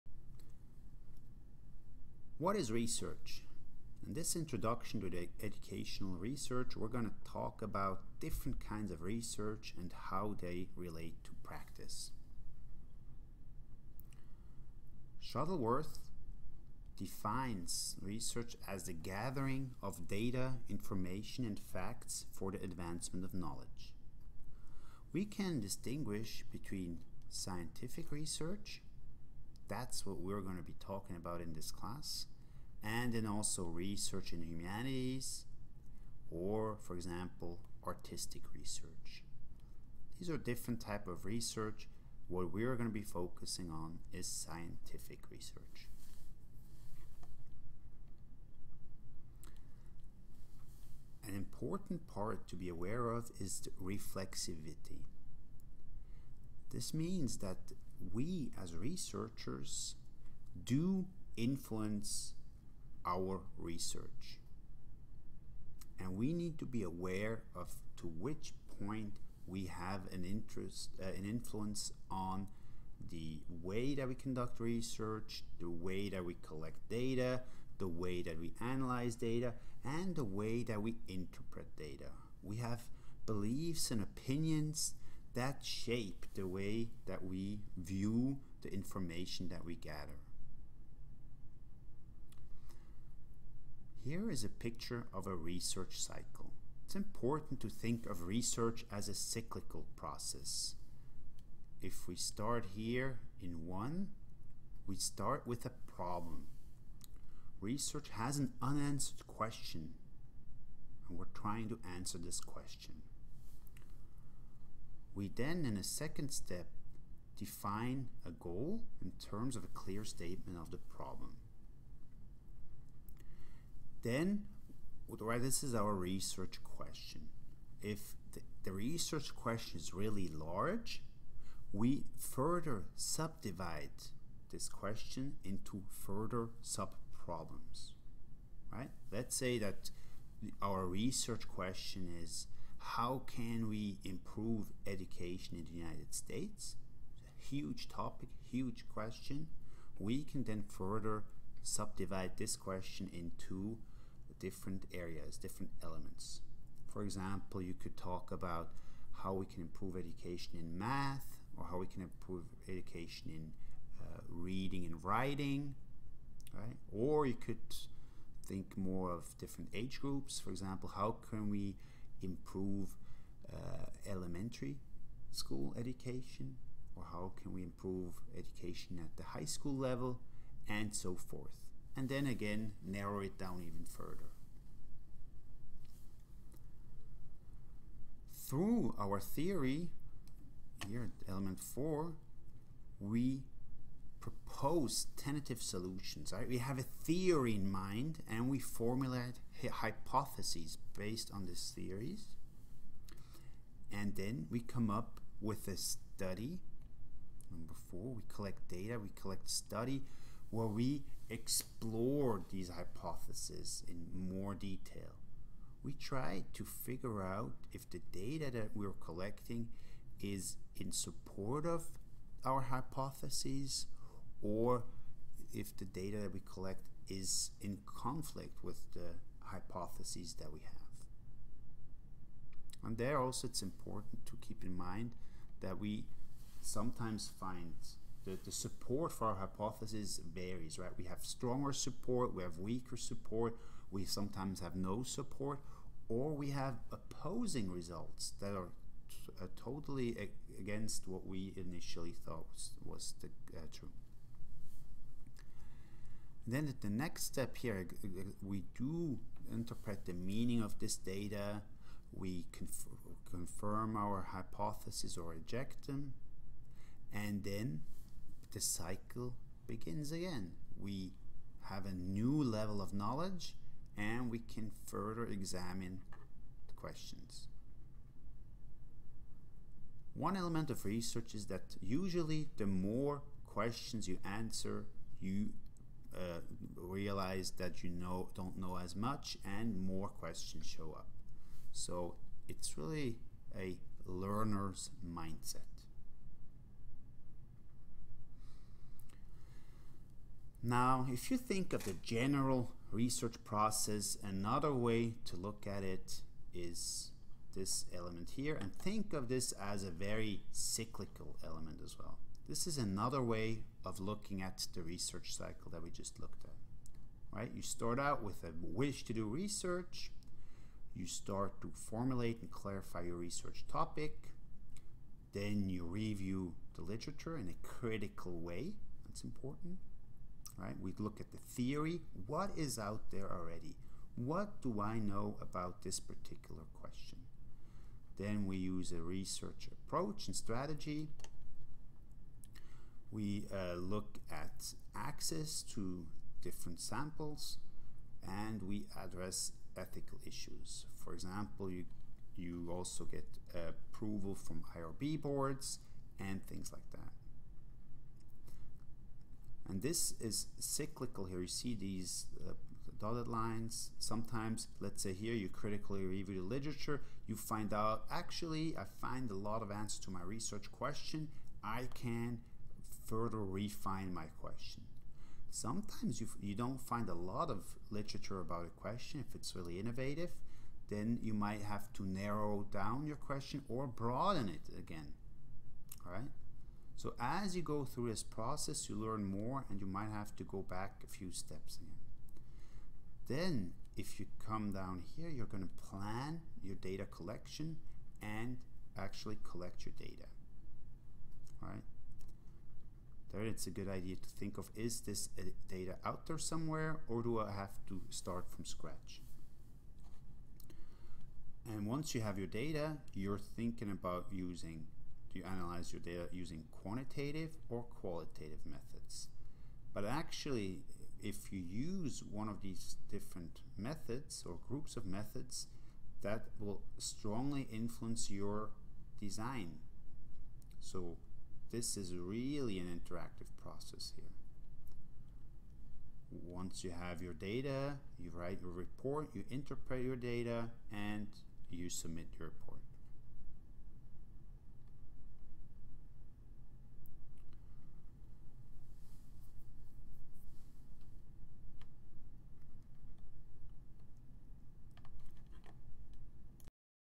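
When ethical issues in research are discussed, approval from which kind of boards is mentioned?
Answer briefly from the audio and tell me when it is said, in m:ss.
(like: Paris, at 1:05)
IRB boards, at 5:54.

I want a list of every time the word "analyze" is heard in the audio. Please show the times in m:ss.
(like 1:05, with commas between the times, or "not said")
1:18, 6:55.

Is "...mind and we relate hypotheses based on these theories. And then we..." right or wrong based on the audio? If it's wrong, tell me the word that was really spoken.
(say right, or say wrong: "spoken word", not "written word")
wrong: "formulate", not "relate".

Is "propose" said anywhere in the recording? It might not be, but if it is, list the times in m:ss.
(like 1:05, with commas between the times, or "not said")
3:14.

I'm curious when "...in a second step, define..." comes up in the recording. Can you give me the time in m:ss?
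1:55.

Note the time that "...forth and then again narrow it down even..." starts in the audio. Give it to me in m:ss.
3:01.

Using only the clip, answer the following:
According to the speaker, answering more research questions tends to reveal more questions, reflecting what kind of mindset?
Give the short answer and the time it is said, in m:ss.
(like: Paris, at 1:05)
A learner's mindset, at 4:54.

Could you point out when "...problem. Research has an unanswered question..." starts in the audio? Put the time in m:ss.
1:45.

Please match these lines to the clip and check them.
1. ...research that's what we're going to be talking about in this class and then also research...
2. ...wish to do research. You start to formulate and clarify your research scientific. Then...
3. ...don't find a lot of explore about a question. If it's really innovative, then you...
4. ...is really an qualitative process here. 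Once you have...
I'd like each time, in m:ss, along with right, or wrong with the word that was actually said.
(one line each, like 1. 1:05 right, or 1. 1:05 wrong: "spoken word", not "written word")
1. 0:28 right
2. 5:18 wrong: "topic", not "scientific"
3. 6:16 wrong: "literature", not "explore"
4. 7:11 wrong: "interactive", not "qualitative".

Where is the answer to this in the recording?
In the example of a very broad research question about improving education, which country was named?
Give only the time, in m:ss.
2:25.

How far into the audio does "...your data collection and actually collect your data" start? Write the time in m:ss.
6:36.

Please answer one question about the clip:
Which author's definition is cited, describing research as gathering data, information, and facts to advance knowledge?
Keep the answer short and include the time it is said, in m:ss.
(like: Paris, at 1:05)
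Shuttleworth, at 0:15.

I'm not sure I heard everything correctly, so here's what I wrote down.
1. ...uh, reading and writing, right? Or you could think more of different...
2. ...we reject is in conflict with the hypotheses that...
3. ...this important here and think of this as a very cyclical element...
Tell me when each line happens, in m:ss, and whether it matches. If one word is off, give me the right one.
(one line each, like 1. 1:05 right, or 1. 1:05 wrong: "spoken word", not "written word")
1. 2:43 right
2. 3:46 wrong: "collect", not "reject"
3. 5:07 wrong: "element", not "important".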